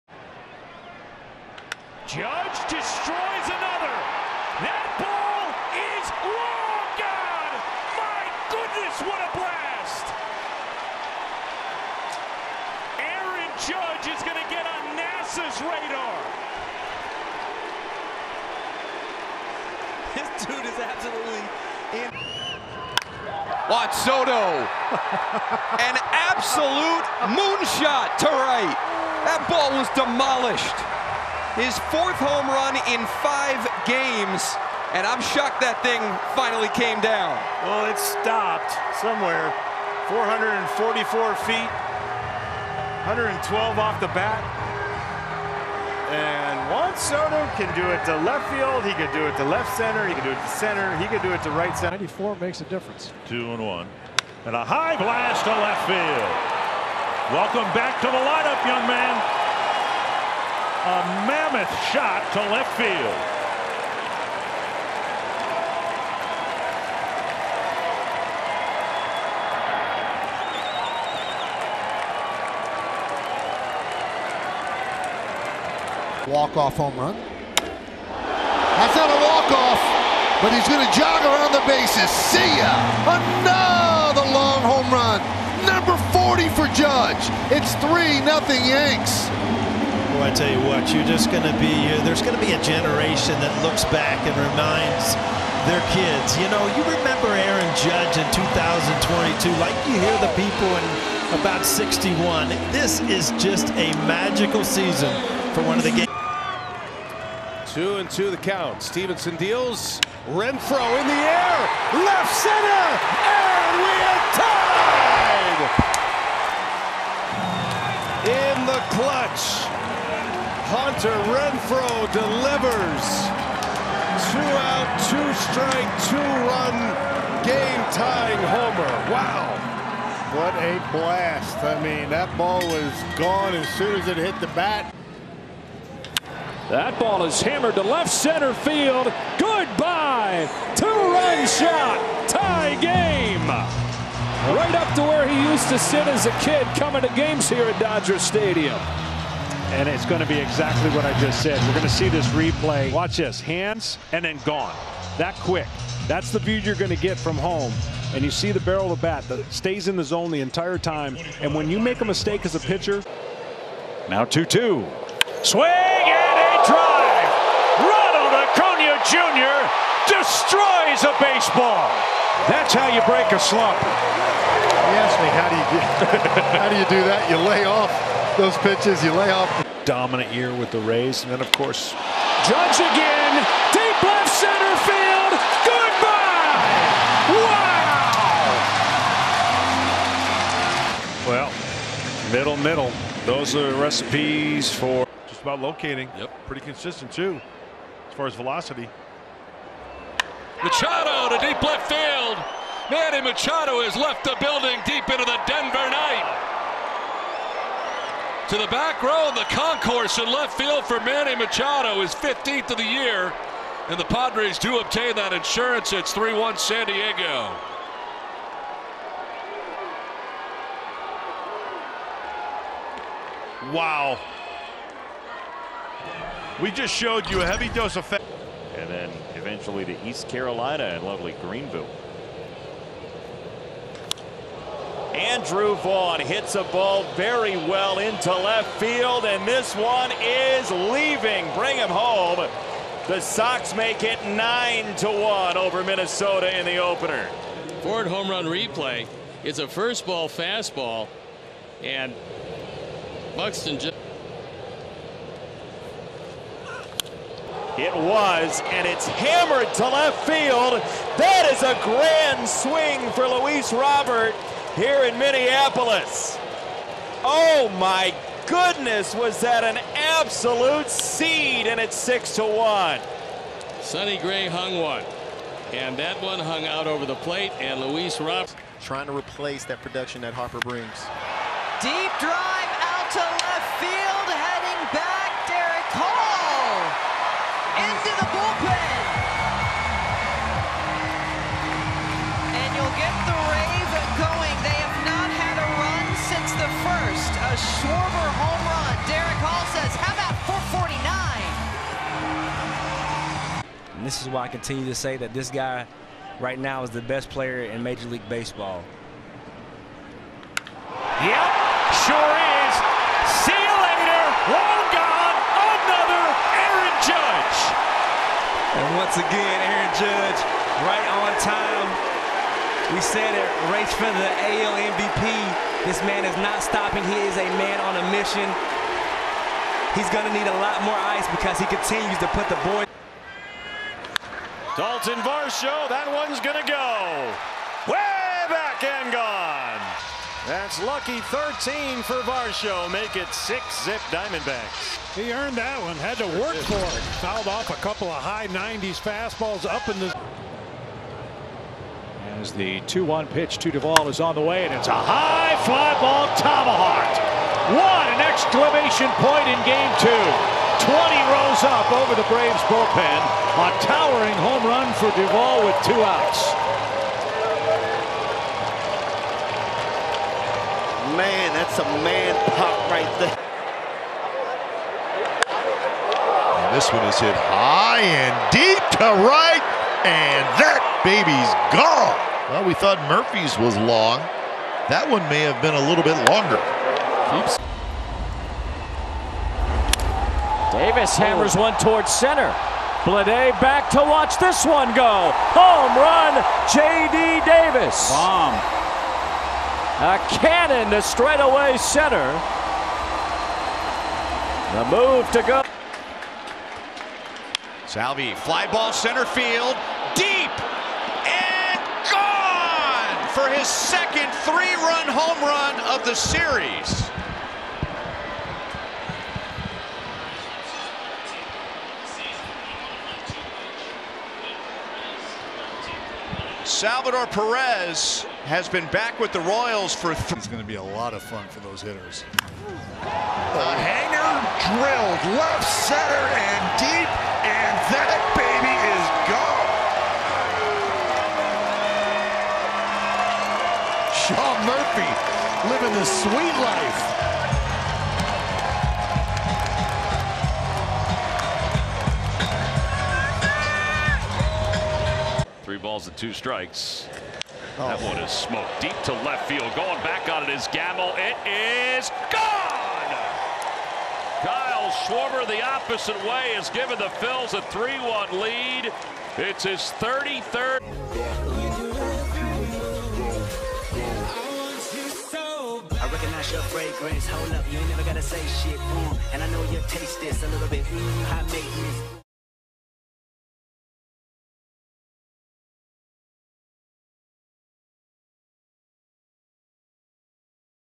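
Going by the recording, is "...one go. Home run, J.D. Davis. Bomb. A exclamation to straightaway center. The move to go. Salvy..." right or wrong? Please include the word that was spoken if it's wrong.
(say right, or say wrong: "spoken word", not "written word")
wrong: "cannon", not "exclamation".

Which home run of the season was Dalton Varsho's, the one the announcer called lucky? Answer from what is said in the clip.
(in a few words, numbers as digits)
13.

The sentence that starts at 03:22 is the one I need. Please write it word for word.
Manny Machado has left the building deep into the Denver night.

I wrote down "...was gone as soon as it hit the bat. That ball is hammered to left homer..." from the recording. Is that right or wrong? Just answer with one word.
wrong.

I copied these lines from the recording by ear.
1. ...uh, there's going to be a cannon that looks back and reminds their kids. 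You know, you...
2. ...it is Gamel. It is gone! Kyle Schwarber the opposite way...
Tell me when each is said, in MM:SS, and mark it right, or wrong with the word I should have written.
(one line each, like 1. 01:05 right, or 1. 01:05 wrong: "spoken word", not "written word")
1. 01:31 wrong: "generation", not "cannon"
2. 07:40 right.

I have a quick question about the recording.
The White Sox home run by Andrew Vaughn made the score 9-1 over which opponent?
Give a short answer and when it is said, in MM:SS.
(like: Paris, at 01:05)
Minnesota, at 04:05.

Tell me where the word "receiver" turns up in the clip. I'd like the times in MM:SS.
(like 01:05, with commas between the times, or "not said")
not said.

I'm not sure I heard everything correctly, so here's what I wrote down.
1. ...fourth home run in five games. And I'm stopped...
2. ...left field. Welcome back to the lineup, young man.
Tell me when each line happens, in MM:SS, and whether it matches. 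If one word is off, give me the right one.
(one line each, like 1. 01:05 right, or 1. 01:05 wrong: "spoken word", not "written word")
1. 00:31 wrong: "shocked", not "stopped"
2. 00:55 right.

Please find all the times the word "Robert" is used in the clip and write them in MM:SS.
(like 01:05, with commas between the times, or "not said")
04:23, 04:38.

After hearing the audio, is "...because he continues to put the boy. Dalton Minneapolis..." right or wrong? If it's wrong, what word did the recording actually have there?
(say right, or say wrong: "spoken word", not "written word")
wrong: "Varsho", not "Minneapolis".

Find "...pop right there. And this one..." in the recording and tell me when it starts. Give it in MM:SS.
06:12.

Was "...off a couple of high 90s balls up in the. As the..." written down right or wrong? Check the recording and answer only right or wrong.
wrong.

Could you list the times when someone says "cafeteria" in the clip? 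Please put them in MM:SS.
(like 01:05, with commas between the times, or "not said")
not said.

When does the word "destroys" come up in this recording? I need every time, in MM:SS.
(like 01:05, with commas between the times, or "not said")
00:02, 02:50.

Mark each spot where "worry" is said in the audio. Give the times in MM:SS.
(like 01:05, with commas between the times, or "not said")
not said.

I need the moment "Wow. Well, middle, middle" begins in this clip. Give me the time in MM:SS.
03:11.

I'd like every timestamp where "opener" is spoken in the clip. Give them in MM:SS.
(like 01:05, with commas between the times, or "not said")
04:06.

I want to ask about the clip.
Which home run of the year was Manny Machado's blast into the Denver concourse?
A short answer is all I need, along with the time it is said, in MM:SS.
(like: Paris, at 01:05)
15, at 03:32.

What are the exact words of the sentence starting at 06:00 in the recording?
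Twenty rows up over the Braves bullpen.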